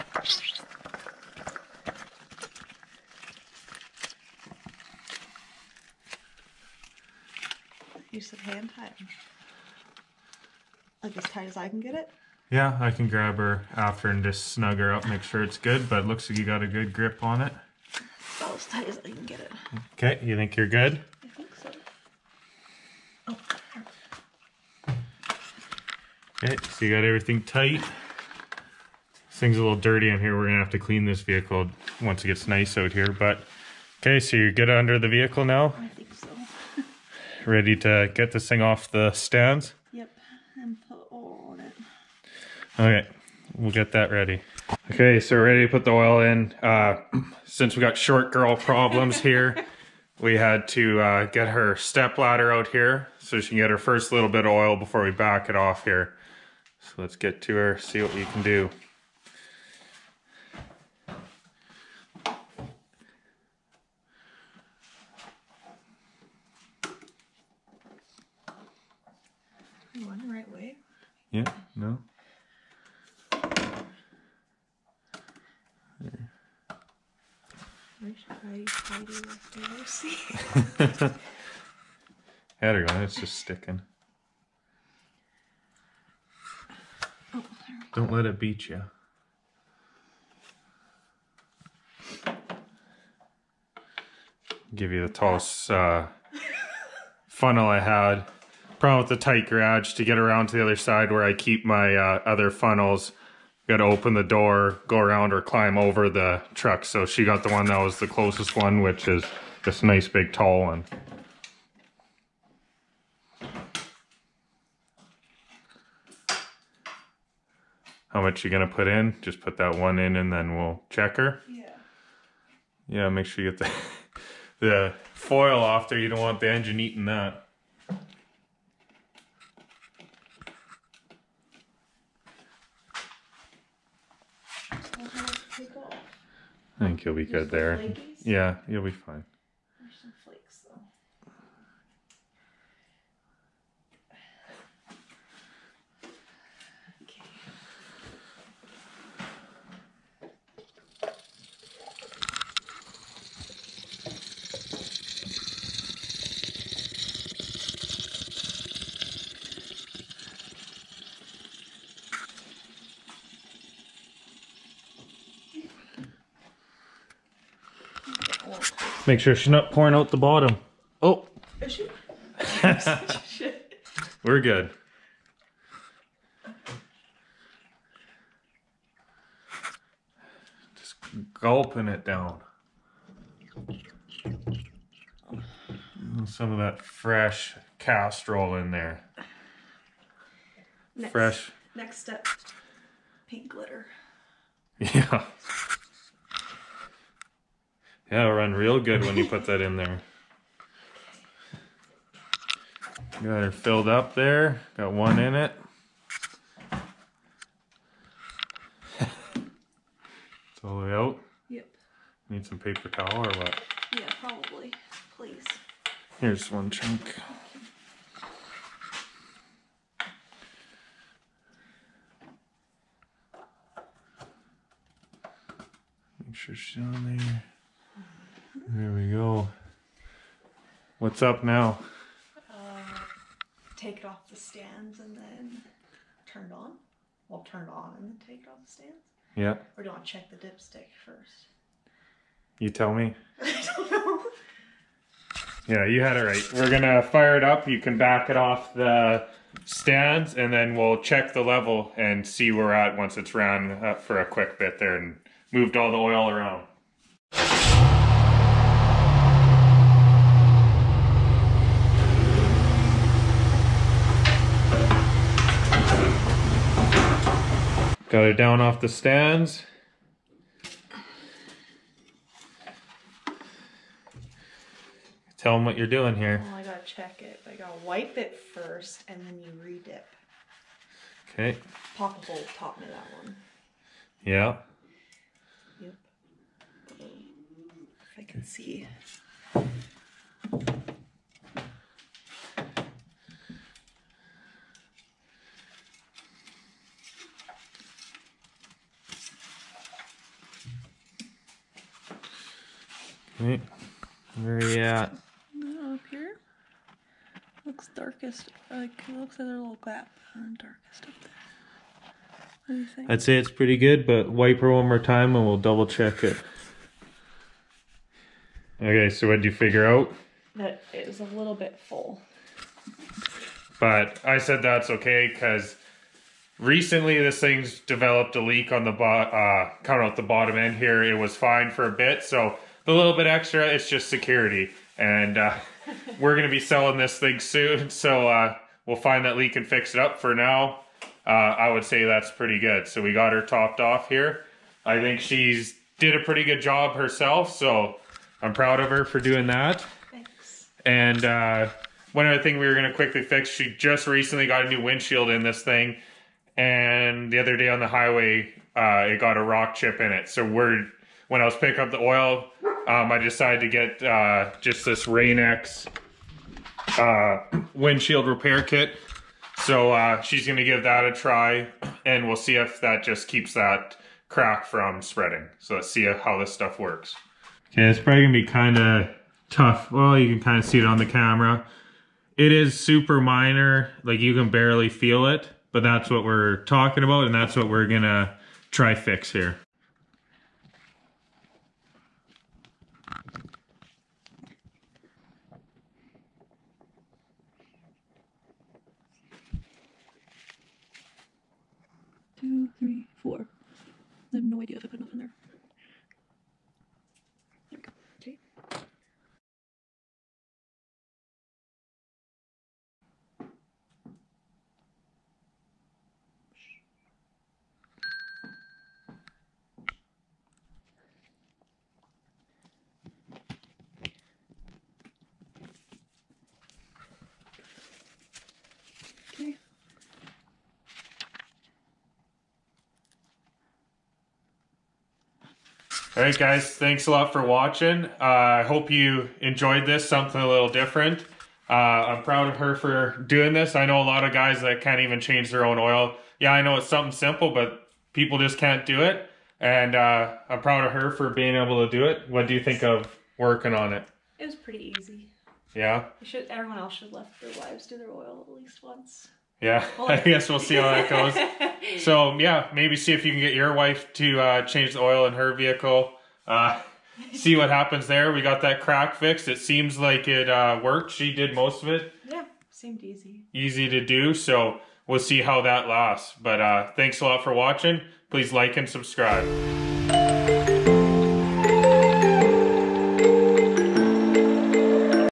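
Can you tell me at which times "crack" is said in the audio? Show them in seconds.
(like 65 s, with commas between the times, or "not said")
374 s, 468 s.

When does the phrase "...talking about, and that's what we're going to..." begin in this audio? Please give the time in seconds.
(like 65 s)
386 s.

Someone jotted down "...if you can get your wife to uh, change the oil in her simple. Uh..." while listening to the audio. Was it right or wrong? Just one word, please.
wrong.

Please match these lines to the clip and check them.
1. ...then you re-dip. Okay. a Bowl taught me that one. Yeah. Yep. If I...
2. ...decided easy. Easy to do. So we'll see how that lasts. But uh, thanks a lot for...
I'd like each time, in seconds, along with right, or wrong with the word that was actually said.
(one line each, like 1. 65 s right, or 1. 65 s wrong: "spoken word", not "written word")
1. 279 s right
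2. 472 s wrong: "seemed", not "decided".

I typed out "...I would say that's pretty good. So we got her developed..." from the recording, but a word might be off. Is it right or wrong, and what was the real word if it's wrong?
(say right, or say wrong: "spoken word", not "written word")
wrong: "topped", not "developed".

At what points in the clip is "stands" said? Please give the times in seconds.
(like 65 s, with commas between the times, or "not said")
39 s, 234 s, 238 s, 249 s, 268 s.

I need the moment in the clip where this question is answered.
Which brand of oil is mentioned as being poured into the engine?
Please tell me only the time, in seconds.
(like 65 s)
187 s.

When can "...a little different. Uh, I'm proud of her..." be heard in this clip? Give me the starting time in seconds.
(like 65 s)
440 s.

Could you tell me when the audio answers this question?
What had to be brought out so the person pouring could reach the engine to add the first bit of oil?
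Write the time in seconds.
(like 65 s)
51 s.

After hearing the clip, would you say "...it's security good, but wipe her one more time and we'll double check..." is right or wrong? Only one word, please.
wrong.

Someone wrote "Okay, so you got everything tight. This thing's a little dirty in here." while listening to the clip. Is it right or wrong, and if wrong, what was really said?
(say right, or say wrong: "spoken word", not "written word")
right.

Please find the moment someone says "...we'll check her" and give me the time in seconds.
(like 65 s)
120 s.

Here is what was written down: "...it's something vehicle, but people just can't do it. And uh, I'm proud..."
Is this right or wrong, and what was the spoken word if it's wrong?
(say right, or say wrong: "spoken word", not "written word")
wrong: "simple", not "vehicle".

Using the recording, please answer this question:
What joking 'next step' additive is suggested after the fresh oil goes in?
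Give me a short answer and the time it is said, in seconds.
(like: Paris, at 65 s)
Paint glitter, at 193 s.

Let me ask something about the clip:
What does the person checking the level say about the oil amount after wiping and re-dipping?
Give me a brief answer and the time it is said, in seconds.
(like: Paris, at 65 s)
A little bit full, at 321 s.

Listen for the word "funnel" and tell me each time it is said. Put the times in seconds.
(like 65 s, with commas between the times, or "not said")
97 s, 102 s.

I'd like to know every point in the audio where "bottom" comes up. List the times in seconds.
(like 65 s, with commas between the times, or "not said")
170 s, 330 s.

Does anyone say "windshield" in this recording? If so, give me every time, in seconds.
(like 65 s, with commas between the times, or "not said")
354 s, 367 s.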